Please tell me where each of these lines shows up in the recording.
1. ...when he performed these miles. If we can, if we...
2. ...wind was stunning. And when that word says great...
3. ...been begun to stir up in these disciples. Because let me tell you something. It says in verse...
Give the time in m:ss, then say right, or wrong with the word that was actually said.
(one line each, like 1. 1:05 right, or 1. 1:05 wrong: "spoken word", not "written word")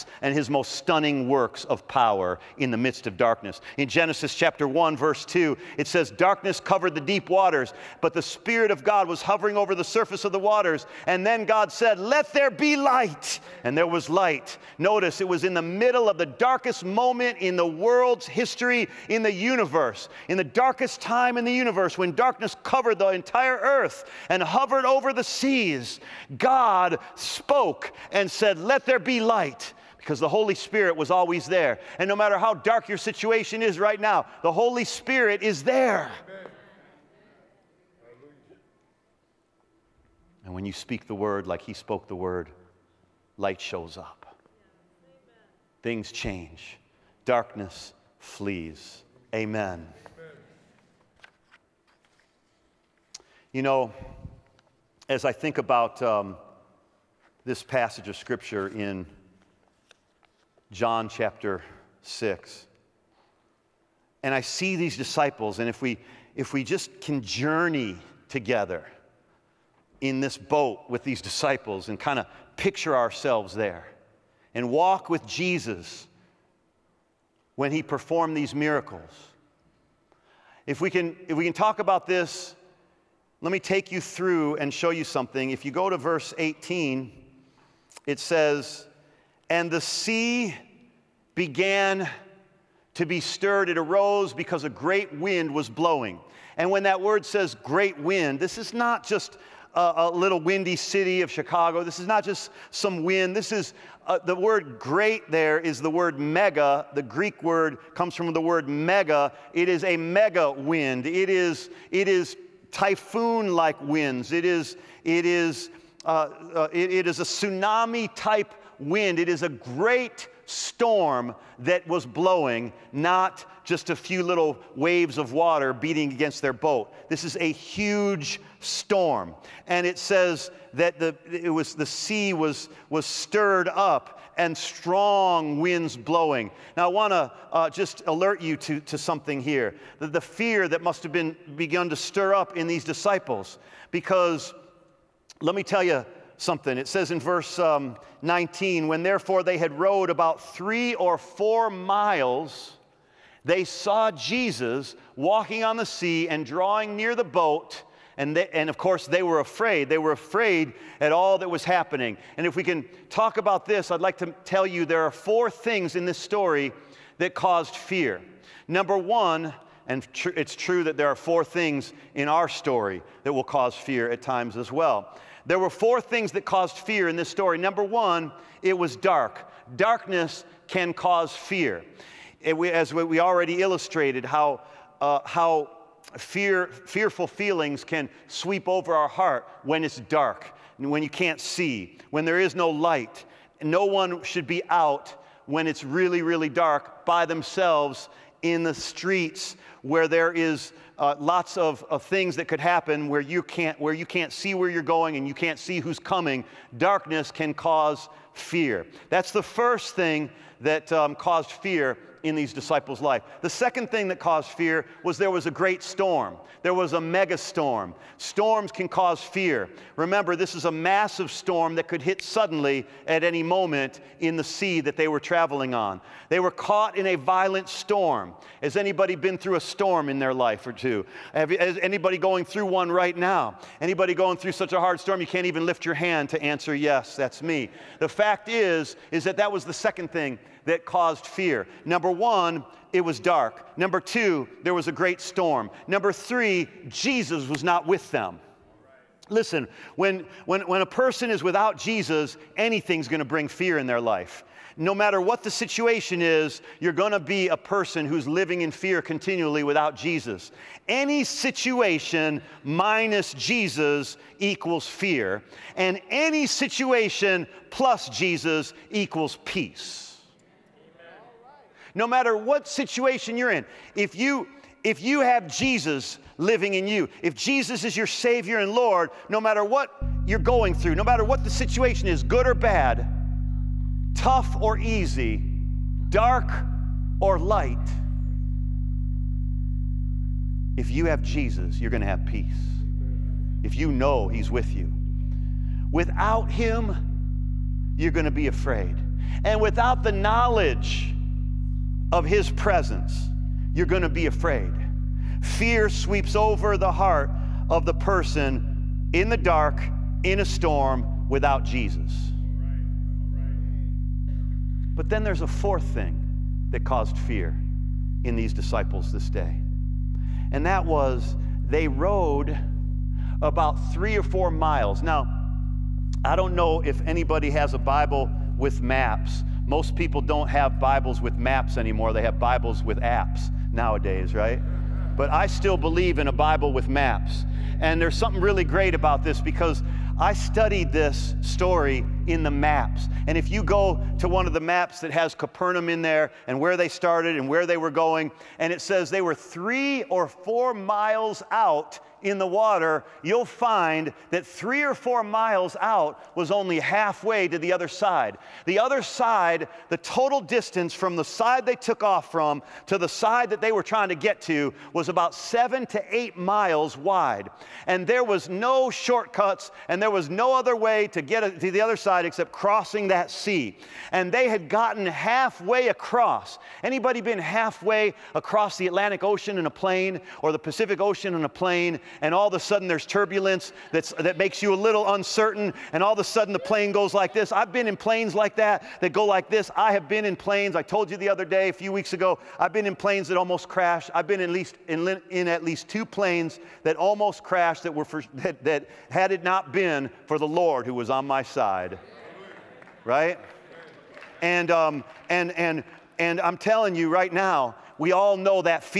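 1. 1:17 wrong: "miracles", not "miles"
2. 1:35 wrong: "blowing", not "stunning"
3. 2:21 right.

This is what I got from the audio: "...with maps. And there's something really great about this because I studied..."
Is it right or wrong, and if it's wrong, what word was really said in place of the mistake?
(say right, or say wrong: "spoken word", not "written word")
right.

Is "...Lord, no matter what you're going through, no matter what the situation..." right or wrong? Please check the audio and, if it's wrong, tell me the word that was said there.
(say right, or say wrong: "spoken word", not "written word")
right.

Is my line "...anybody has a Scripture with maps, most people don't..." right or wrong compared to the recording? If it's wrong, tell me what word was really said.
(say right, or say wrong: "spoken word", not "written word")
wrong: "Bible", not "Scripture".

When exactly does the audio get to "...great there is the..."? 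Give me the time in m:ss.
1:44.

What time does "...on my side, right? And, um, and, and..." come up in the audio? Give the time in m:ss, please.
6:41.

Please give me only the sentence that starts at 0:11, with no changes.
And then God said, Let there be light.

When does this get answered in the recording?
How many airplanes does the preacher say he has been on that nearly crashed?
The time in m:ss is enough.
6:35.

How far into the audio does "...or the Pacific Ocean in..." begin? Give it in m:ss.
6:20.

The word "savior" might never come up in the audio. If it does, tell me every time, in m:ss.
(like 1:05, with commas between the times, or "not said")
4:38.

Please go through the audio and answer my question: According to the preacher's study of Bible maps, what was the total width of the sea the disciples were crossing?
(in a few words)
7 to 8 miles.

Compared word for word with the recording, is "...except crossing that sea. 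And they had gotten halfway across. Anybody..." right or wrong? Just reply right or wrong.
right.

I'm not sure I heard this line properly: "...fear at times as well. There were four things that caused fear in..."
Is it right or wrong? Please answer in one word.
right.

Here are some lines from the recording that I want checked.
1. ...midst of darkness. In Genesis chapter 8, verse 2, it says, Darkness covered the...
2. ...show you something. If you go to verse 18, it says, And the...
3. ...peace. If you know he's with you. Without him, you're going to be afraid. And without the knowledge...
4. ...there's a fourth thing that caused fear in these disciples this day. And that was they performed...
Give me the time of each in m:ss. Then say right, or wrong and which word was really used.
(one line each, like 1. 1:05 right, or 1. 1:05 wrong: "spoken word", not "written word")
1. 0:02 wrong: "1", not "8"
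2. 1:24 right
3. 4:52 right
4. 5:15 wrong: "rowed", not "performed".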